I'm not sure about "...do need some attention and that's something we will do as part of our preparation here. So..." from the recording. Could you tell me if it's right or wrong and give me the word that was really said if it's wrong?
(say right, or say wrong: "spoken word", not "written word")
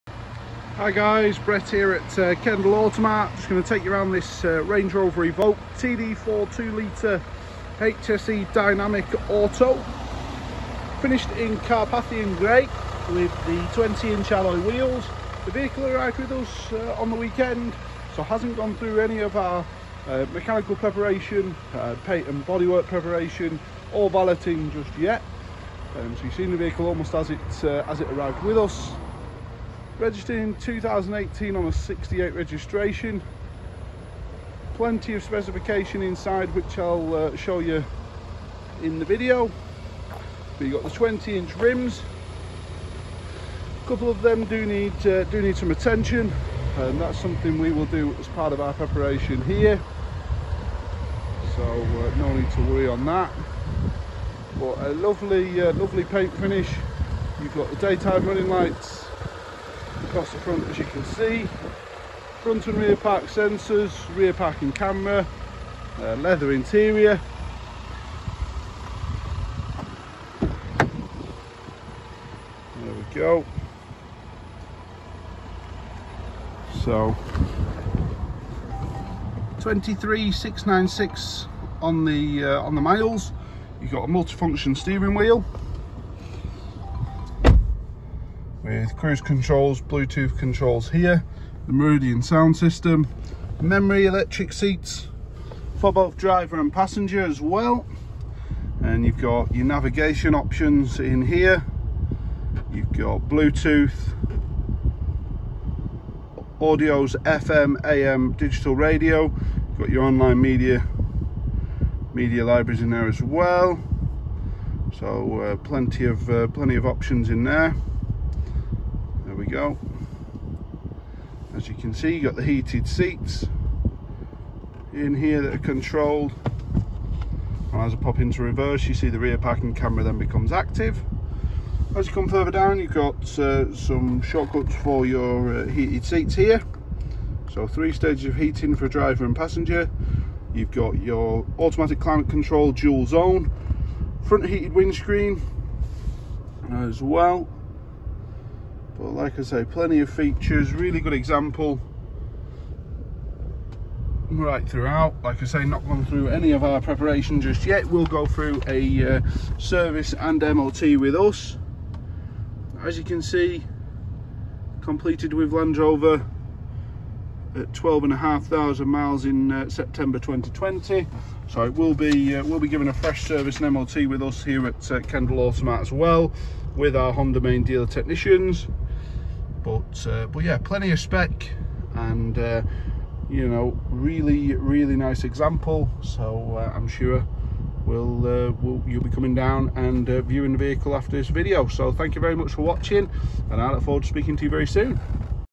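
right.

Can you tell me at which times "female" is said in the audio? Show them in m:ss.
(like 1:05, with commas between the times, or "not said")
not said.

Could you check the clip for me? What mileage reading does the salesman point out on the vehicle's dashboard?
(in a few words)
23696.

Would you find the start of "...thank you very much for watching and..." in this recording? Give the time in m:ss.
3:11.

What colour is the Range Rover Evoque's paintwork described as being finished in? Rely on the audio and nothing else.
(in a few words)
Carpathian Grey.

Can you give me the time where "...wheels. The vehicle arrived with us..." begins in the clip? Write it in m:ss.
0:14.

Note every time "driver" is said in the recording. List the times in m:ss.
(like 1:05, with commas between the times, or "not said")
1:36, 2:18.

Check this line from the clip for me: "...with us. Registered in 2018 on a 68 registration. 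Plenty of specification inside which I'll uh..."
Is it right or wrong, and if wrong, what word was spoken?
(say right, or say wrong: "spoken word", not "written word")
right.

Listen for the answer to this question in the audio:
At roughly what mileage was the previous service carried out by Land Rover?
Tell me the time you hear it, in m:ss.
2:47.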